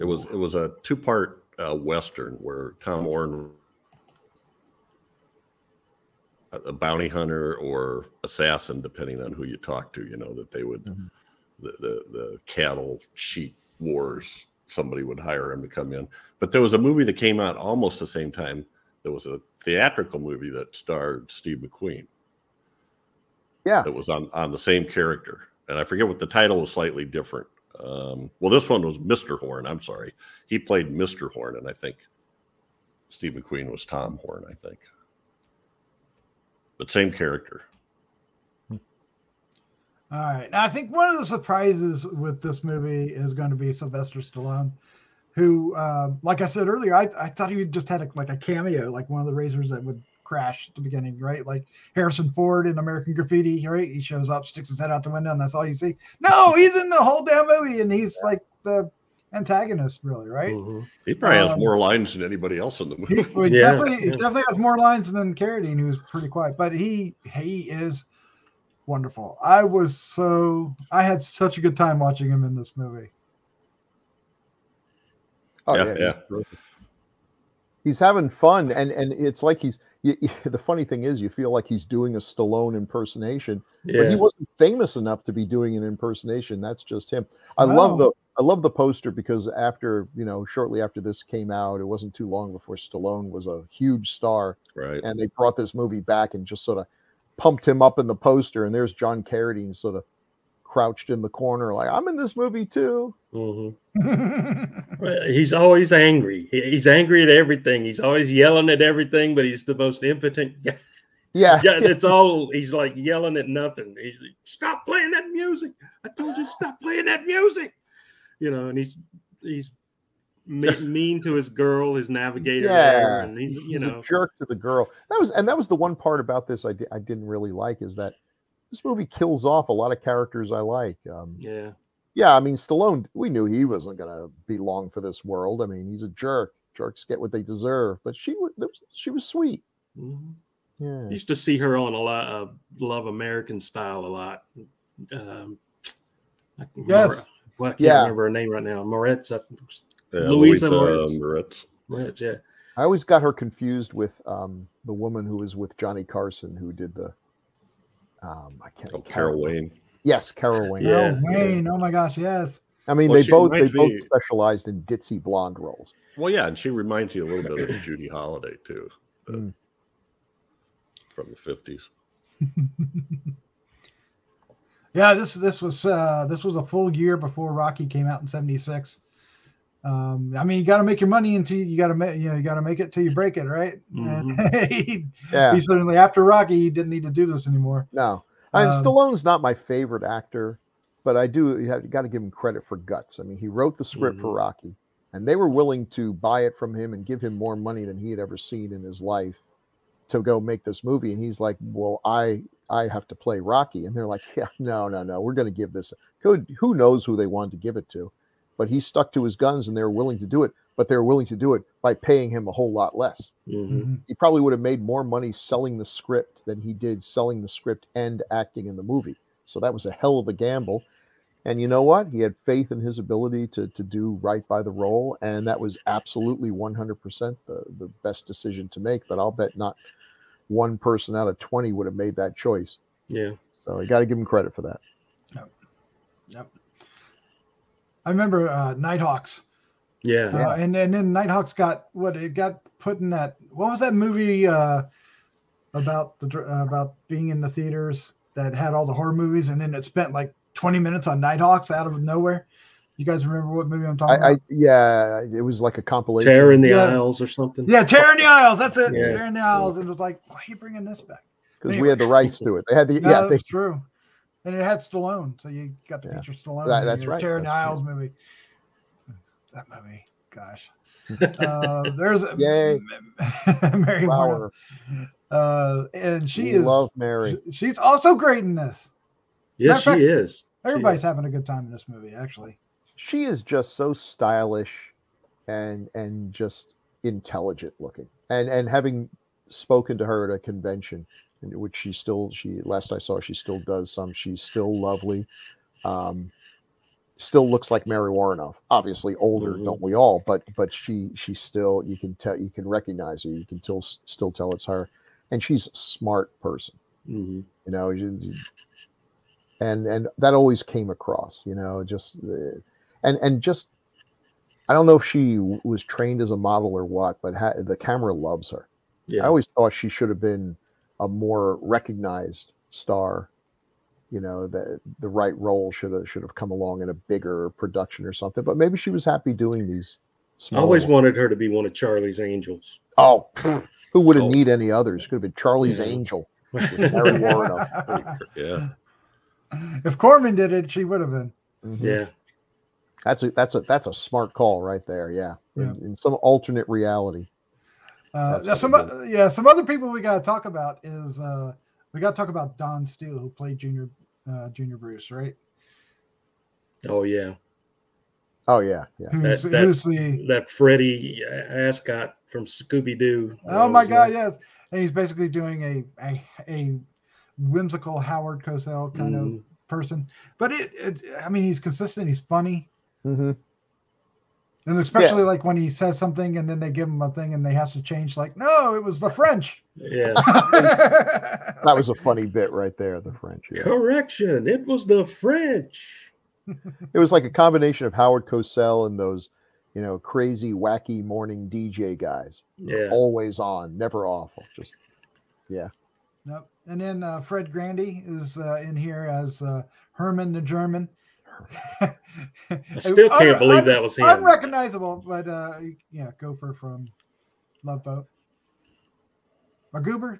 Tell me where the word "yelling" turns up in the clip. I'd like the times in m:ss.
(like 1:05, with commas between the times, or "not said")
1:48, 1:52.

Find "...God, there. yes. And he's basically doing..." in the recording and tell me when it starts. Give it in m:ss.
6:03.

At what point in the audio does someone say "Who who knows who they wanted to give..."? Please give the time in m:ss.
3:26.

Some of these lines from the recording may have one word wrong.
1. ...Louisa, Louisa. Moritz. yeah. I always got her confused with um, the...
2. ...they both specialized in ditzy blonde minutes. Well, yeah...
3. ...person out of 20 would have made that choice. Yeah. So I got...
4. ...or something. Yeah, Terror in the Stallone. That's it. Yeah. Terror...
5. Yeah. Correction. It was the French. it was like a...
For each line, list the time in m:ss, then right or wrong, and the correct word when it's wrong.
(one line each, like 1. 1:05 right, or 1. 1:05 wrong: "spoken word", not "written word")
1. 2:30 wrong: "Moritz", not "Louisa"
2. 2:43 wrong: "roles", not "minutes"
3. 3:50 right
4. 4:17 wrong: "Aisles", not "Stallone"
5. 6:23 right.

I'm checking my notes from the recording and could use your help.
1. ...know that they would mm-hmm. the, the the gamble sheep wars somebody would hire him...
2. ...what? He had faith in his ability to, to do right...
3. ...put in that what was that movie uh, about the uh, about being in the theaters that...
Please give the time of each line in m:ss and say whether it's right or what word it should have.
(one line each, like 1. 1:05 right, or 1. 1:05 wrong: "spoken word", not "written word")
1. 0:10 wrong: "cattle", not "gamble"
2. 3:41 right
3. 4:02 right.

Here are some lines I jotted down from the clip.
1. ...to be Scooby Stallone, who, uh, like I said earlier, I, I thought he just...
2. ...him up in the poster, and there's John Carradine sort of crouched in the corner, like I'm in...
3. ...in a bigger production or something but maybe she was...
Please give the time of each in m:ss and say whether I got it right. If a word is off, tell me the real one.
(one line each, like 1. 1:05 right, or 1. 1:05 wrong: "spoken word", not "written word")
1. 0:43 wrong: "Sylvester", not "Scooby"
2. 1:37 right
3. 5:26 right.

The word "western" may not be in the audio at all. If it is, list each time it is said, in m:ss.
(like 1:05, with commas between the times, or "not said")
0:01.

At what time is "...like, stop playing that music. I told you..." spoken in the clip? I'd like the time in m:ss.
1:54.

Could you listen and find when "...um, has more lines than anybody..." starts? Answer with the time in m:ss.
1:01.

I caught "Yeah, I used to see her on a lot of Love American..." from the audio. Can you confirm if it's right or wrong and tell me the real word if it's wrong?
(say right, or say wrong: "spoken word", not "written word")
right.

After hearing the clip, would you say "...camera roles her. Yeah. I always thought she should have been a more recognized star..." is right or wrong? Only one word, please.
wrong.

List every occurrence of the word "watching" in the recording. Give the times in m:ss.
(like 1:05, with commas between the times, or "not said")
1:11.